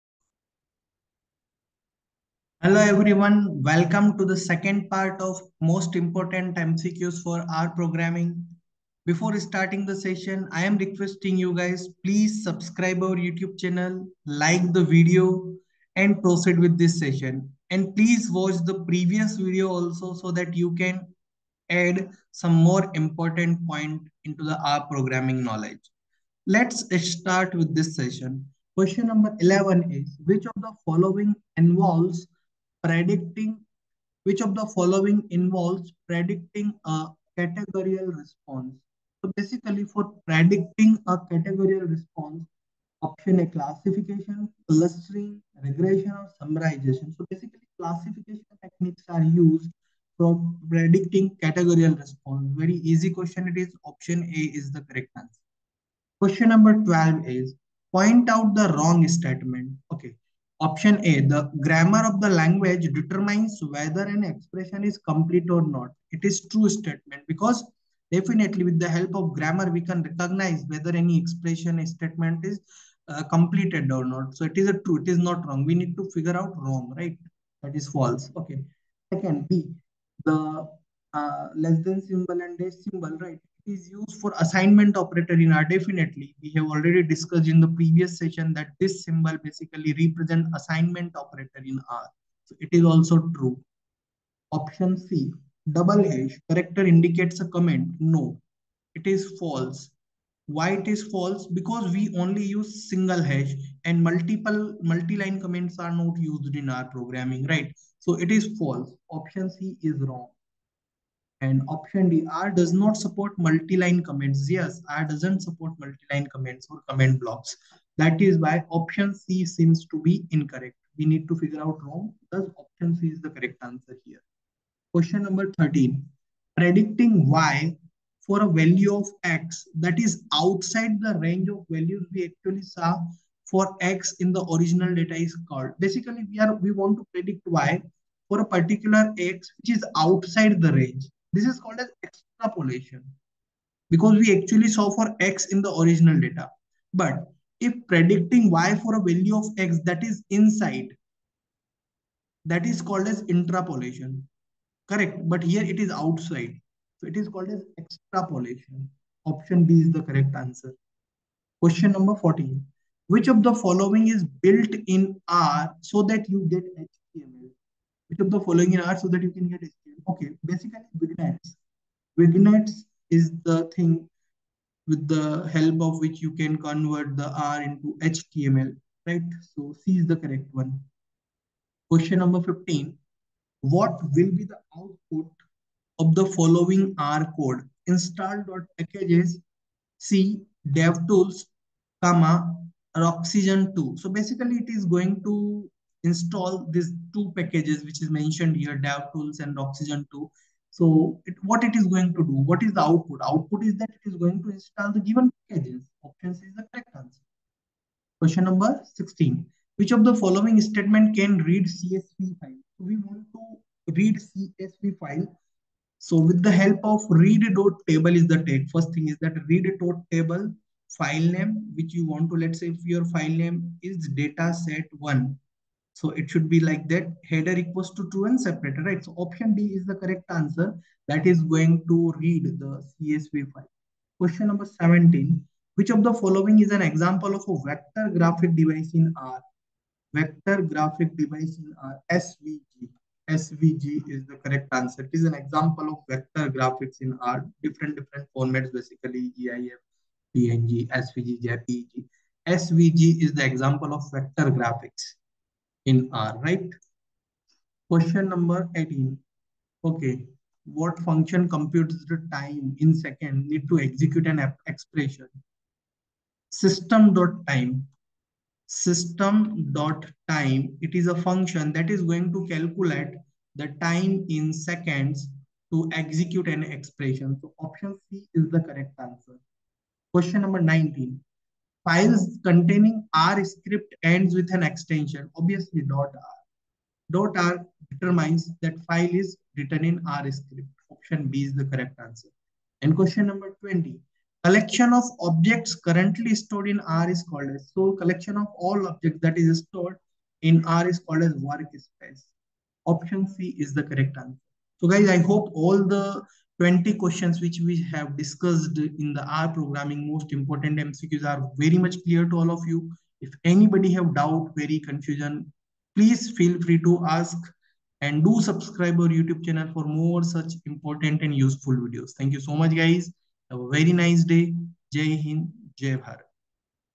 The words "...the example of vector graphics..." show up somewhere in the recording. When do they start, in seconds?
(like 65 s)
253 s.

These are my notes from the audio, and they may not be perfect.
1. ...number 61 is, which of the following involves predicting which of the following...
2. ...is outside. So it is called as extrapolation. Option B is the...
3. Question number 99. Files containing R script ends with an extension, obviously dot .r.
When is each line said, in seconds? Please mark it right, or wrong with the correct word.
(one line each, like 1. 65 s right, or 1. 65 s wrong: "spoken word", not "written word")
1. 29 s wrong: "11", not "61"
2. 155 s right
3. 280 s wrong: "19", not "99".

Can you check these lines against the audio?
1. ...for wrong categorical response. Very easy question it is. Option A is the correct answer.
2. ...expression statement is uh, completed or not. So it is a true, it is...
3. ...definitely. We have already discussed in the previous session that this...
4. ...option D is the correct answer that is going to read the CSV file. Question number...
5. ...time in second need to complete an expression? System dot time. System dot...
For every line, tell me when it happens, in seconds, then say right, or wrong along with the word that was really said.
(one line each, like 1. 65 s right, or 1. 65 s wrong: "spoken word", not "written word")
1. 50 s wrong: "predicting", not "wrong"
2. 71 s right
3. 85 s right
4. 229 s right
5. 262 s wrong: "execute", not "complete".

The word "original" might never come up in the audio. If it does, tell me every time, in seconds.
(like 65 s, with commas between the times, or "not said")
134 s, 145 s.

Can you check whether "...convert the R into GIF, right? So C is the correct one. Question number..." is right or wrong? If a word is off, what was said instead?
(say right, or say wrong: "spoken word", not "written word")
wrong: "HTML", not "GIF".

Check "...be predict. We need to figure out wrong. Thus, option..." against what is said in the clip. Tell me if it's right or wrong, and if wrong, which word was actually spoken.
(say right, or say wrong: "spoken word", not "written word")
wrong: "incorrect", not "predict".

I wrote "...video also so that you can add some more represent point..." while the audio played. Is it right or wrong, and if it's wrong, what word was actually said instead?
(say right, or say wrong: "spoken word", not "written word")
wrong: "important", not "represent".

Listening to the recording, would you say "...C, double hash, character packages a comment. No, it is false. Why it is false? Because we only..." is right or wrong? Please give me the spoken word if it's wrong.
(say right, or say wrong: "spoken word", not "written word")
wrong: "indicates", not "packages".